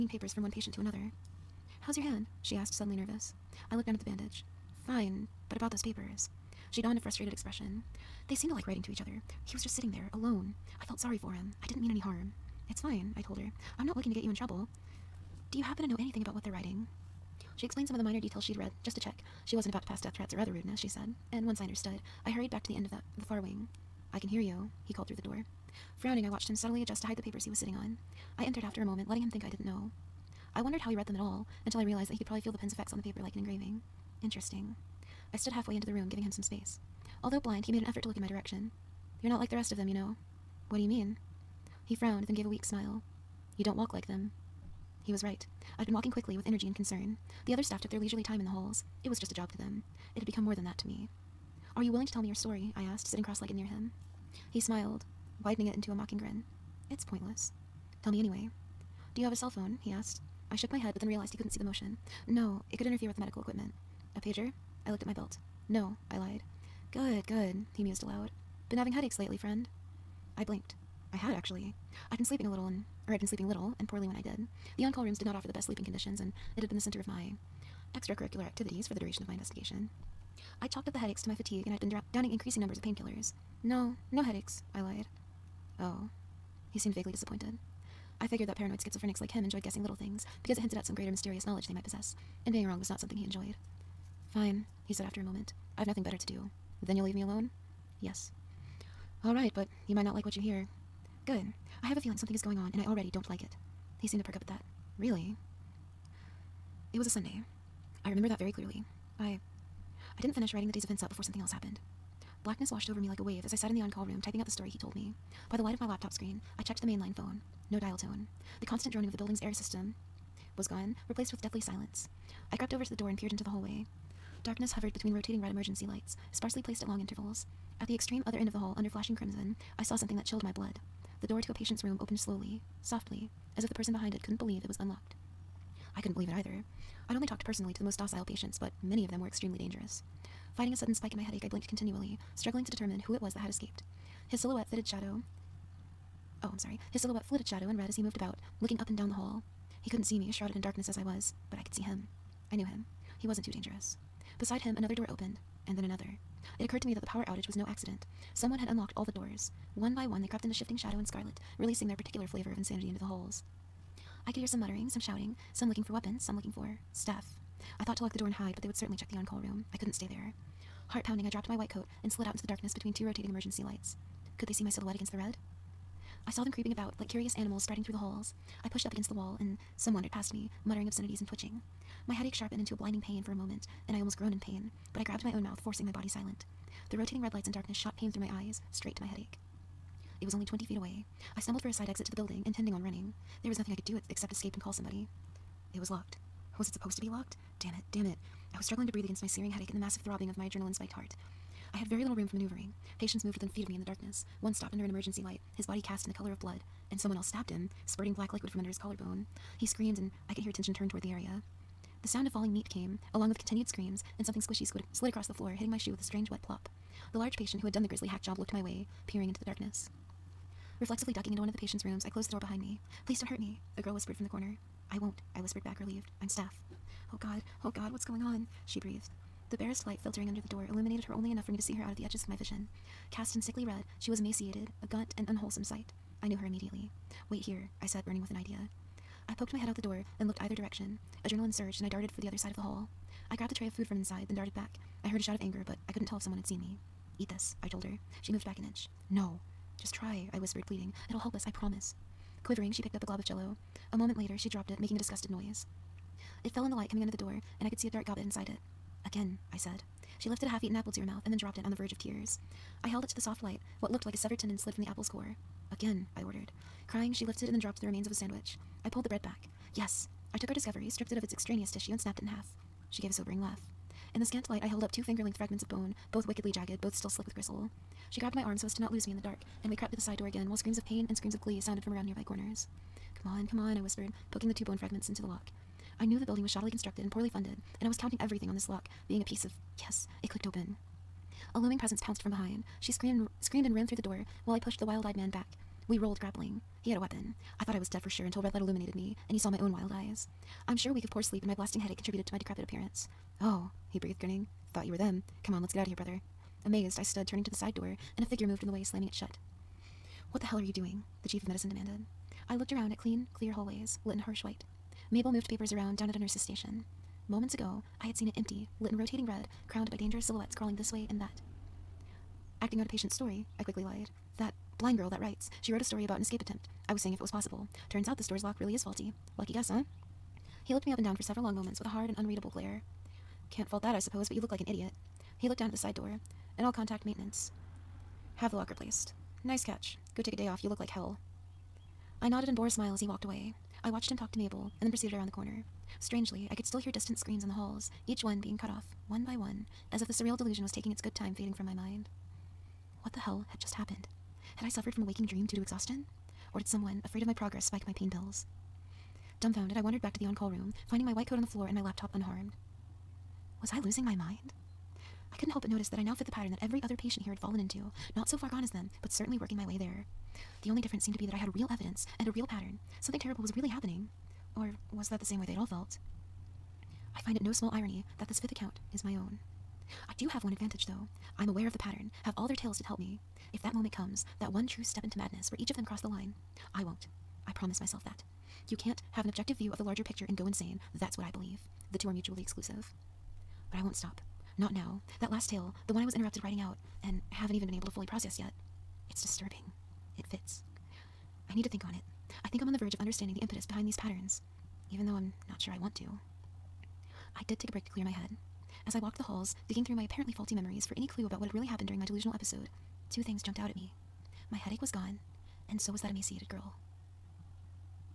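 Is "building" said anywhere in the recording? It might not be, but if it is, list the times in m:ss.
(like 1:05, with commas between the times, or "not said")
1:59, 3:12, 4:46.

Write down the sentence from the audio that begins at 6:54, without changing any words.
My headache was gone, and so was that emaciated girl.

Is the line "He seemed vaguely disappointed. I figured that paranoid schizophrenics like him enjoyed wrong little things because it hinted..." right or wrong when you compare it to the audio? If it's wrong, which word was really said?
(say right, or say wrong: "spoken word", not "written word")
wrong: "guessing", not "wrong".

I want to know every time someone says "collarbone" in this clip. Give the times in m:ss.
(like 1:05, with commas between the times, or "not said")
3:28.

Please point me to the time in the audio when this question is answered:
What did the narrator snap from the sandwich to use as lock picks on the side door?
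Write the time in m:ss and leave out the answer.
4:44.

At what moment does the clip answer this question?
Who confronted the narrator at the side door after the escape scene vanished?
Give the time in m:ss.
5:11.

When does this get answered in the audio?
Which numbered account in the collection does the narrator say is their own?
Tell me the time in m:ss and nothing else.
6:18.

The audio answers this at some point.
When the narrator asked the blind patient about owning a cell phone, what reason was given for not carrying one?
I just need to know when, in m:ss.
1:02.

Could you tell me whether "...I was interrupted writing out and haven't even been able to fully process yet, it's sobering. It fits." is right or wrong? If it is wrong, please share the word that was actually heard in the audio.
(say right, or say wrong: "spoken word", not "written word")
wrong: "disturbing", not "sobering".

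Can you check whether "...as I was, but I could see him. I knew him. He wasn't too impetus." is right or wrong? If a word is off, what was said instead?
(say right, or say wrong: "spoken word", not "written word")
wrong: "dangerous", not "impetus".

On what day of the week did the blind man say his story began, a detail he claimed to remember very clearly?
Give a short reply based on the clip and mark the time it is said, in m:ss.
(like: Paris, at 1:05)
Sunday, at 1:47.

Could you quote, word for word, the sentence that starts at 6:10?
The only difference seemed to be that I had real evidence and a real pattern.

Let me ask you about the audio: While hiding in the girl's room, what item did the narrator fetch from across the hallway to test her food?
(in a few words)
A tray of food.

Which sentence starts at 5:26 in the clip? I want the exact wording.
I was seeing if it was possible.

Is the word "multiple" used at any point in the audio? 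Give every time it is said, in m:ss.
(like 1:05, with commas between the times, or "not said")
not said.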